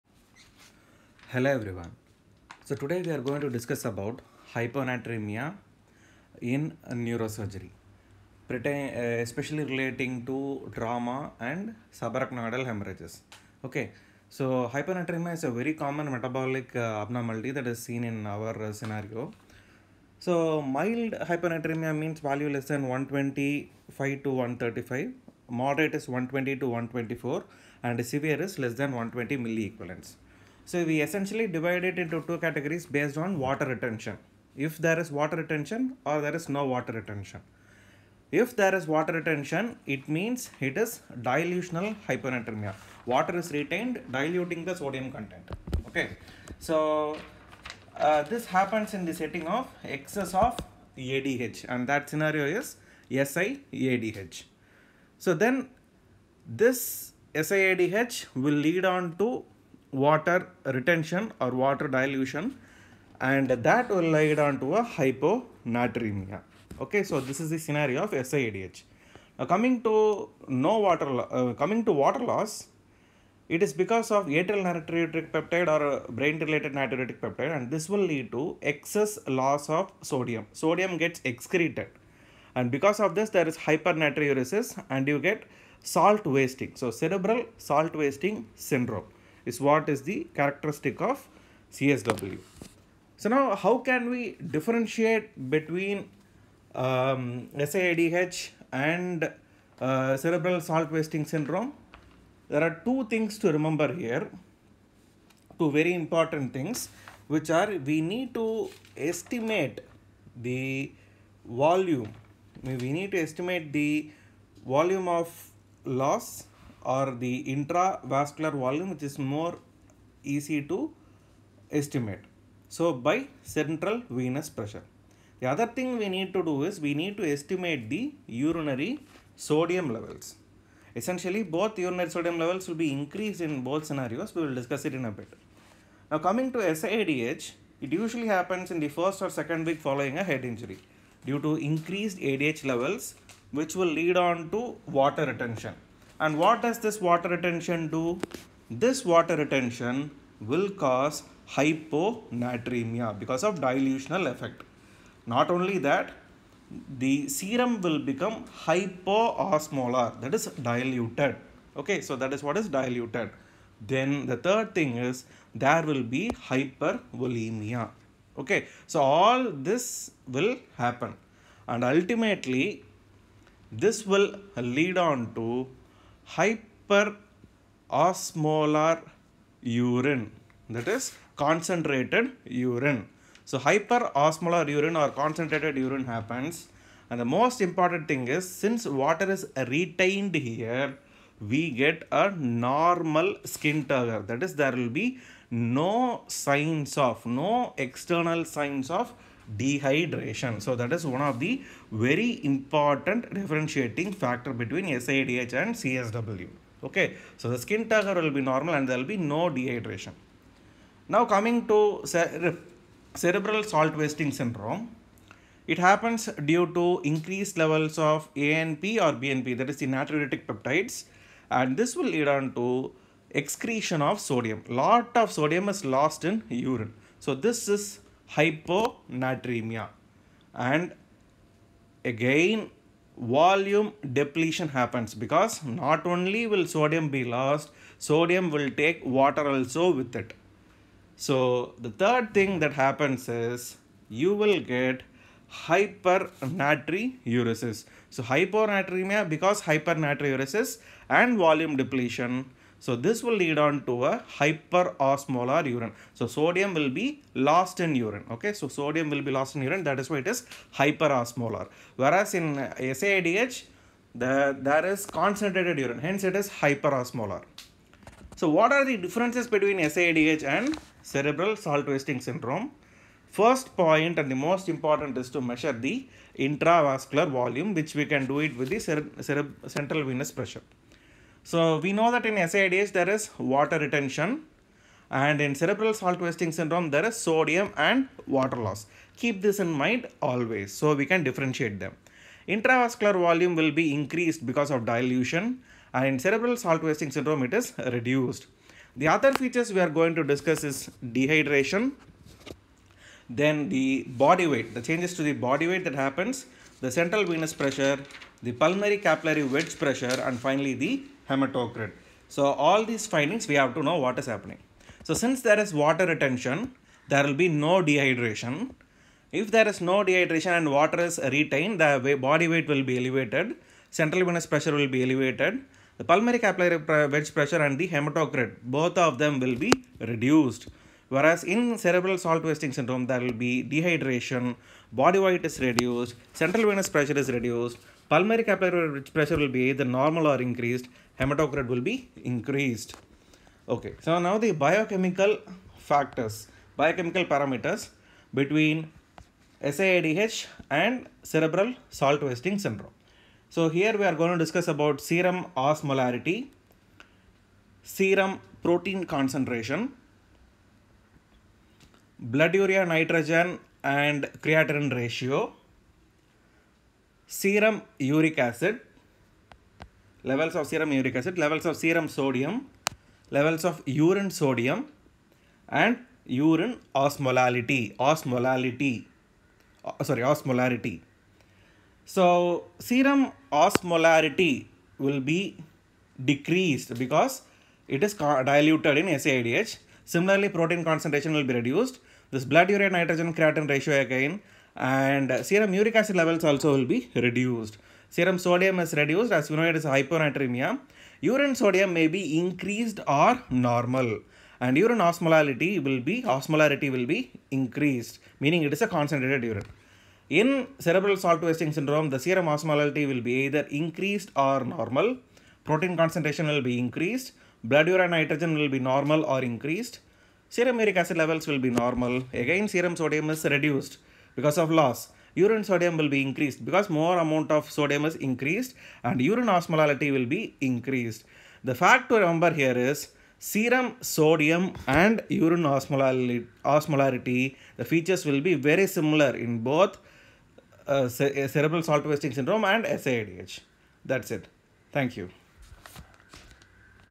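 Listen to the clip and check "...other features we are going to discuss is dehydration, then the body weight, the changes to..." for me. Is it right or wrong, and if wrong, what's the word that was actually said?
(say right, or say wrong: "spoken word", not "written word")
right.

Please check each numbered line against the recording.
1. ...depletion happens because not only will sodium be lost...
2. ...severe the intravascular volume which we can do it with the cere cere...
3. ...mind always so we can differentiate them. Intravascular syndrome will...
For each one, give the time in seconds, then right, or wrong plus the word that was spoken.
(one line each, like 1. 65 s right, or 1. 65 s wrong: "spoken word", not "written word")
1. 234 s right
2. 275 s wrong: "measure", not "severe"
3. 289 s wrong: "volume", not "syndrome".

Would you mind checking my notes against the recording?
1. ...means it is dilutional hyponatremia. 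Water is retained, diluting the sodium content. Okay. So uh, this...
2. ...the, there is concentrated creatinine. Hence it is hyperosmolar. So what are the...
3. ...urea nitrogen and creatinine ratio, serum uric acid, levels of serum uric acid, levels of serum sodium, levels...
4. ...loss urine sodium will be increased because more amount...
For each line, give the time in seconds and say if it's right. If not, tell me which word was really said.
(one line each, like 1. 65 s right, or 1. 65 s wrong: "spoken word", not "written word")
1. 40 s right
2. 264 s wrong: "urine", not "creatinine"
3. 362 s right
4. 424 s right.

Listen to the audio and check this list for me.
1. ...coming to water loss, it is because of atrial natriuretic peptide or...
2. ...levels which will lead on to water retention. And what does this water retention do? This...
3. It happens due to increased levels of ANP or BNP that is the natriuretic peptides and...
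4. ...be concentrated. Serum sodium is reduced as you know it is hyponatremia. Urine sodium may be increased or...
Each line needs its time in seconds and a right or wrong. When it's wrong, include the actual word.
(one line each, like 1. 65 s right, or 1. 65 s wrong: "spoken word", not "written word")
1. 71 s right
2. 142 s right
3. 215 s right
4. 396 s wrong: "reduced", not "concentrated".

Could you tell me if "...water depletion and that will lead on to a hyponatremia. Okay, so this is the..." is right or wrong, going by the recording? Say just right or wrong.
wrong.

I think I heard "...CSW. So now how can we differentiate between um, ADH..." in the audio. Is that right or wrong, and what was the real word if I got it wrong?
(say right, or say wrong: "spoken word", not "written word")
wrong: "SAIDH", not "ADH".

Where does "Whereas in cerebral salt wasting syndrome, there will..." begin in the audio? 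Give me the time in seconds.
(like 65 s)
331 s.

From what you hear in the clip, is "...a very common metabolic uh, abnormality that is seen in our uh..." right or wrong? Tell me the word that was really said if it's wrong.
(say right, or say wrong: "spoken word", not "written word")
right.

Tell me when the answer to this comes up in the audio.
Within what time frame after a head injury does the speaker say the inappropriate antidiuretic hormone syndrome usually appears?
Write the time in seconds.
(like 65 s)
138 s.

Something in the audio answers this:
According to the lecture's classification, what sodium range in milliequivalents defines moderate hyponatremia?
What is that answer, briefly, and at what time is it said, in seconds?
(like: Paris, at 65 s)
120 to 124, at 26 s.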